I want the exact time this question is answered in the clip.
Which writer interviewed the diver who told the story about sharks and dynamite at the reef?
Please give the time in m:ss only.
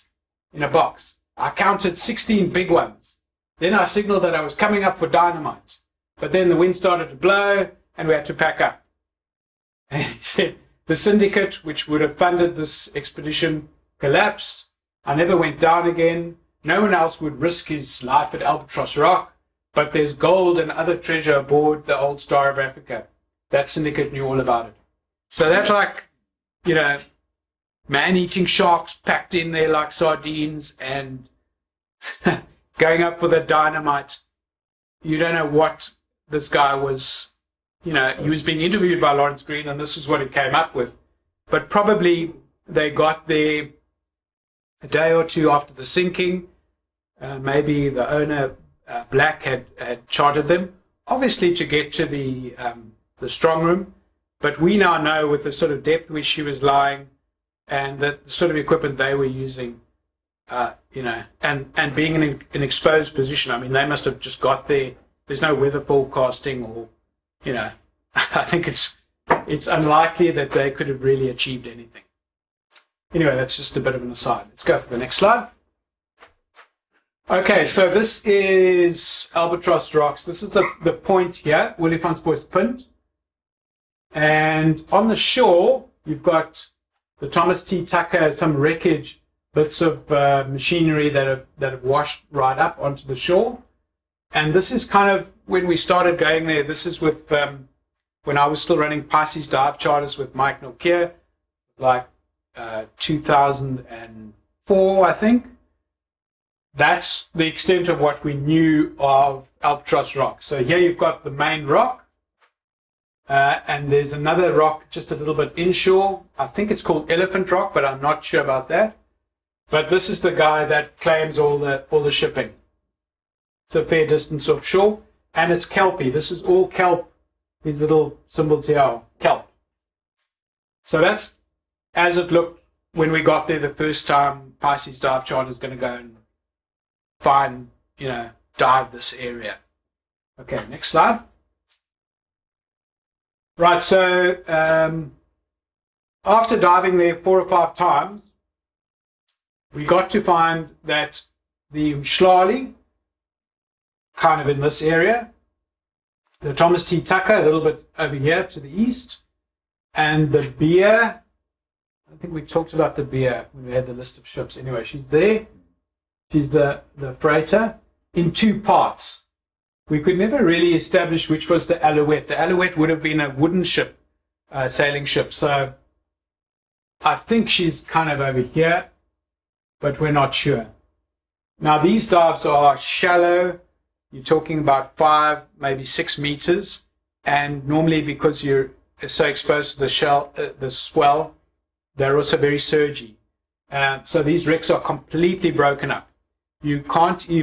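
0:39.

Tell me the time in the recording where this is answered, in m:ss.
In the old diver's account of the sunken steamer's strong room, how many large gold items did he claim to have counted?
0:01.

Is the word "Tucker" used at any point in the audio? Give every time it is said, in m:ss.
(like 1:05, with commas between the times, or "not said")
1:27, 2:37.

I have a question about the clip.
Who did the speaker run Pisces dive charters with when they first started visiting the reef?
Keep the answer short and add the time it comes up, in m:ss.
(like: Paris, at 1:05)
Mike Nokia, at 1:40.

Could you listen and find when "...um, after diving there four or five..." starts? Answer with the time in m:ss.
2:24.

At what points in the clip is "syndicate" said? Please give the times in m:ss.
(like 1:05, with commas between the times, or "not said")
0:10, 0:23.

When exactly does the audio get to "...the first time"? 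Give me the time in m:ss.
2:13.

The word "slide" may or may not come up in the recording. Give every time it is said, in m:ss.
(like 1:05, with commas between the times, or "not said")
1:15, 2:20.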